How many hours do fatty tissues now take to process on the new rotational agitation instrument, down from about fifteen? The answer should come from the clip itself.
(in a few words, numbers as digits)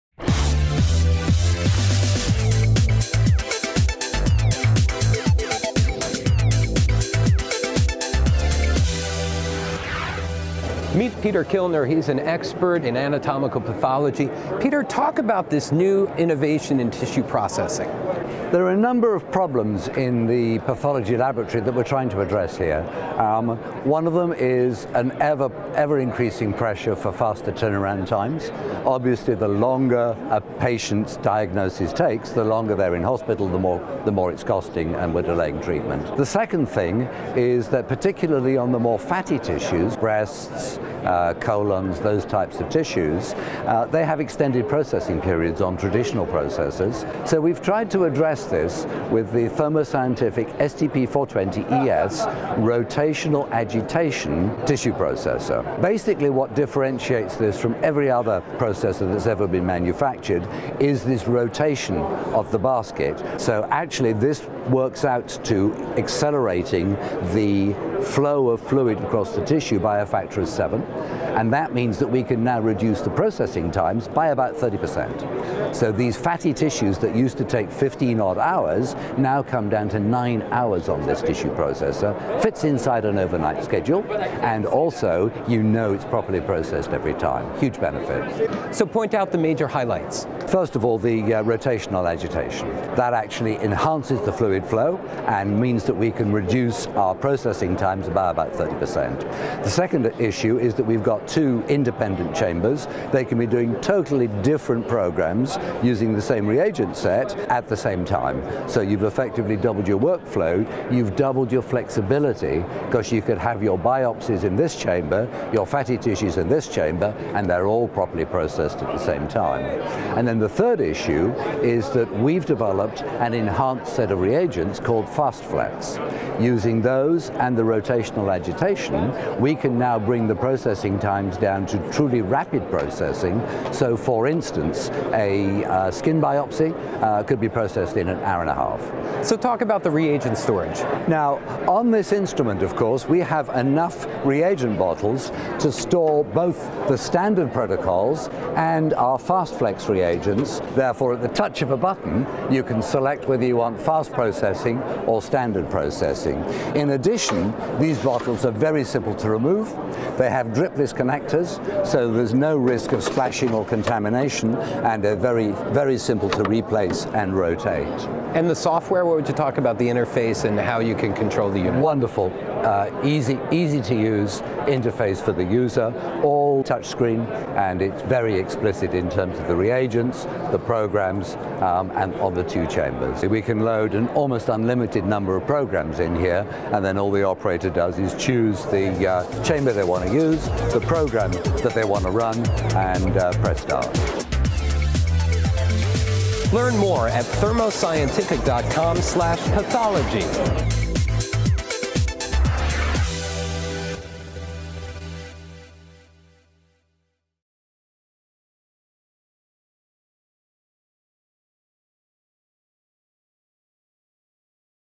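9 hours.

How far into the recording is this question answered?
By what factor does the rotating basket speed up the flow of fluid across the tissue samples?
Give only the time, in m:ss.
1:09.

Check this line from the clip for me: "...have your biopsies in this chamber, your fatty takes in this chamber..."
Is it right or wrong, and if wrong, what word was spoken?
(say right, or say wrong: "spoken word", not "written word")
wrong: "tissues", not "takes".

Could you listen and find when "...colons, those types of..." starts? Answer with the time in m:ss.
0:41.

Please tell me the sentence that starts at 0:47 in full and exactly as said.
So we've tried to address this with the Thermo Scientific STP420ES rotational agitation tissue processor.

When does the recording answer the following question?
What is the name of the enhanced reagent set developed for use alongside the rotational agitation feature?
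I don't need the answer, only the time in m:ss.
2:05.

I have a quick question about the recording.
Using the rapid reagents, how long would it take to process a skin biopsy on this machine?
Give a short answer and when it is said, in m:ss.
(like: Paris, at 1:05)
1.5 hours, at 2:18.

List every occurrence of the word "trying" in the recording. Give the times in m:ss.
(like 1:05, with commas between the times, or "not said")
0:21.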